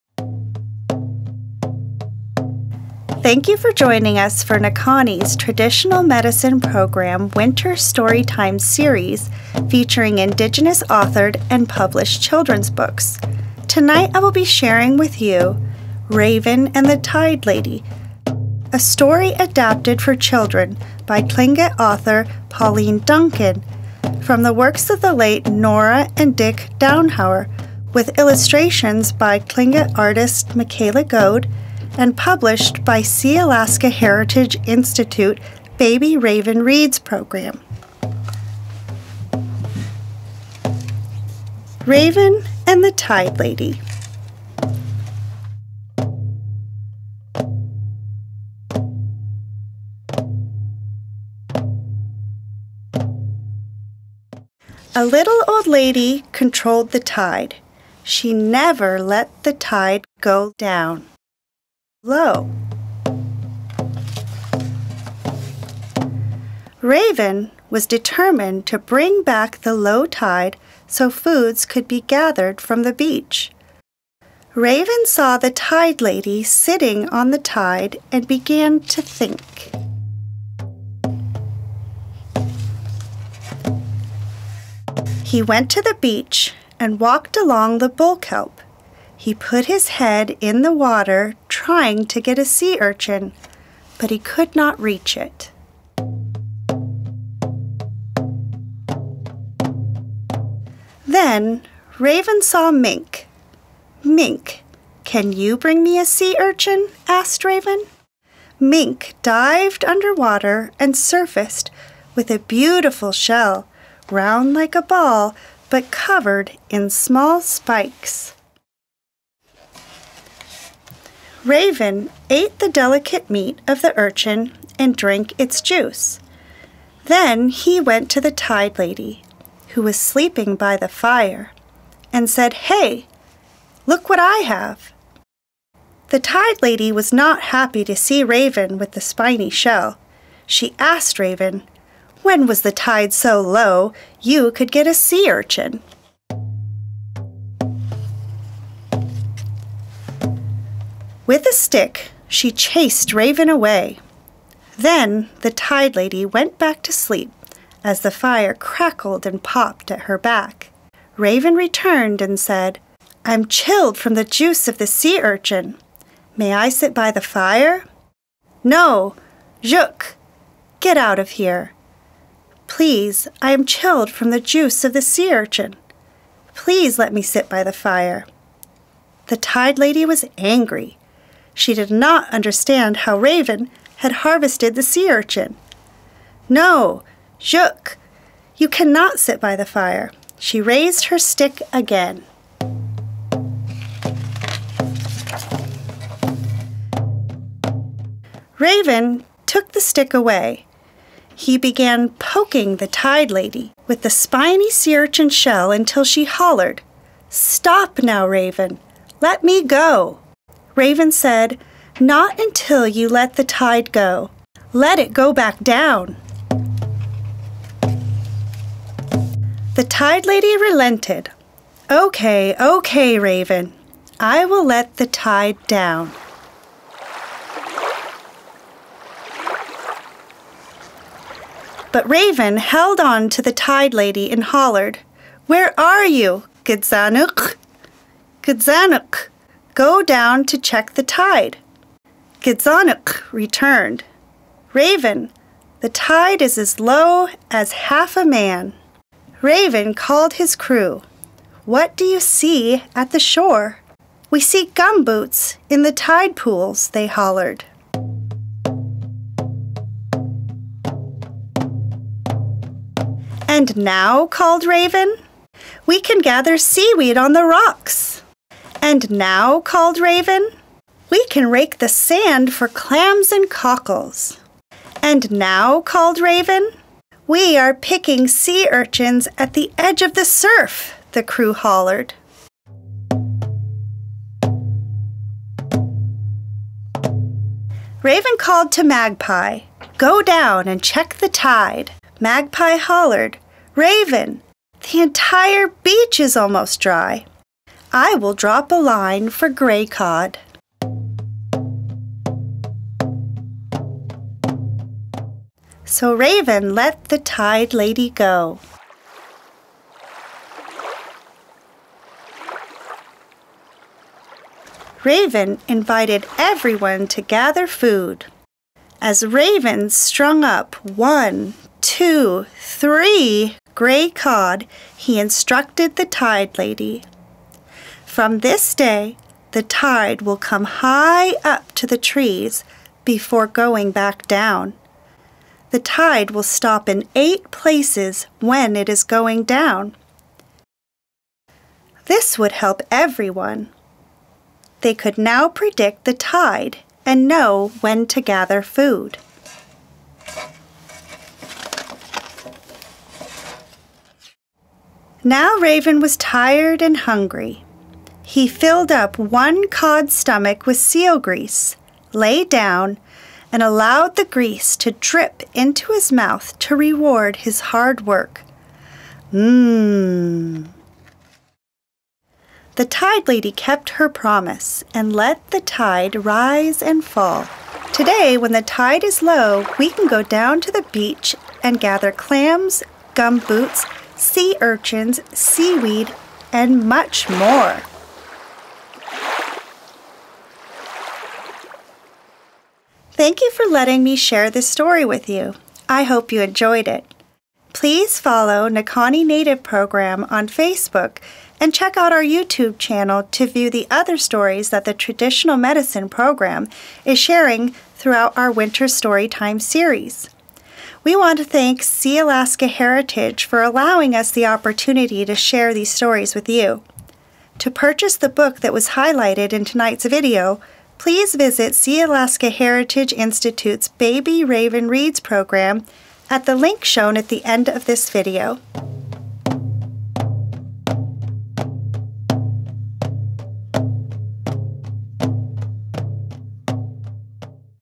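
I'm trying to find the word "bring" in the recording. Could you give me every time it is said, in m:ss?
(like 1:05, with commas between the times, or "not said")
1:08, 1:45.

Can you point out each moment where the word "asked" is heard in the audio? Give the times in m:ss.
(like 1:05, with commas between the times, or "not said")
1:47, 2:20.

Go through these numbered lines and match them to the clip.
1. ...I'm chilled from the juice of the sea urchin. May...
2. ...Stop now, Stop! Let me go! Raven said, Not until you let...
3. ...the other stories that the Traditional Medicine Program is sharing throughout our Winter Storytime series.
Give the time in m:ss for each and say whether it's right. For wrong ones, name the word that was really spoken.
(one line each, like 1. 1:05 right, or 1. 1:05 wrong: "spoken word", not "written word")
1. 2:43 right
2. 3:27 wrong: "Raven", not "Stop"
3. 6:43 right.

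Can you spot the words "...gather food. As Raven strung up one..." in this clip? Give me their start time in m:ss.
5:17.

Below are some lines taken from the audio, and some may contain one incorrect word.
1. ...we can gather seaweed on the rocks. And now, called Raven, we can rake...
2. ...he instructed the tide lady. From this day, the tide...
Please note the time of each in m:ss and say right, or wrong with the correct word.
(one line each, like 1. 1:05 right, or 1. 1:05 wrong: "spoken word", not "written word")
1. 4:25 right
2. 5:24 right.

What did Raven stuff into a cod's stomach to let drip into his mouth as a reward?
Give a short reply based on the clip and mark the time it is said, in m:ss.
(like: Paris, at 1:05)
seal grease, at 6:00.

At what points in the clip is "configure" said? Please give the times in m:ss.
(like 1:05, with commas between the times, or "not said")
not said.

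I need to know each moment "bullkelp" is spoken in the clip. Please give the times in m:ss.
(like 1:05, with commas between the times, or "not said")
1:27.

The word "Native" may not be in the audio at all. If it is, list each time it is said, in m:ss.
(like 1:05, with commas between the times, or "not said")
6:39.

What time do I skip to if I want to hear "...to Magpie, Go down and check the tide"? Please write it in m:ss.
4:48.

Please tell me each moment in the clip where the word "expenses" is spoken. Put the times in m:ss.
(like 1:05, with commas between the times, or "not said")
not said.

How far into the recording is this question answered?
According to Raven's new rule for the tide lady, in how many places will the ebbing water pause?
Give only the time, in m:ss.
5:37.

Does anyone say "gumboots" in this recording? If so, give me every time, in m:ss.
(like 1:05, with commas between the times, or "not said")
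4:14, 6:23.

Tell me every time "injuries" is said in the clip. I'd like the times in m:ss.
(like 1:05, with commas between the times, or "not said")
not said.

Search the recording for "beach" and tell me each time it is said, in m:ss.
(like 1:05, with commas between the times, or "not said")
1:12, 1:26, 4:55, 6:20.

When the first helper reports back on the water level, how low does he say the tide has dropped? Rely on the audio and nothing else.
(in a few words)
as low as half a man.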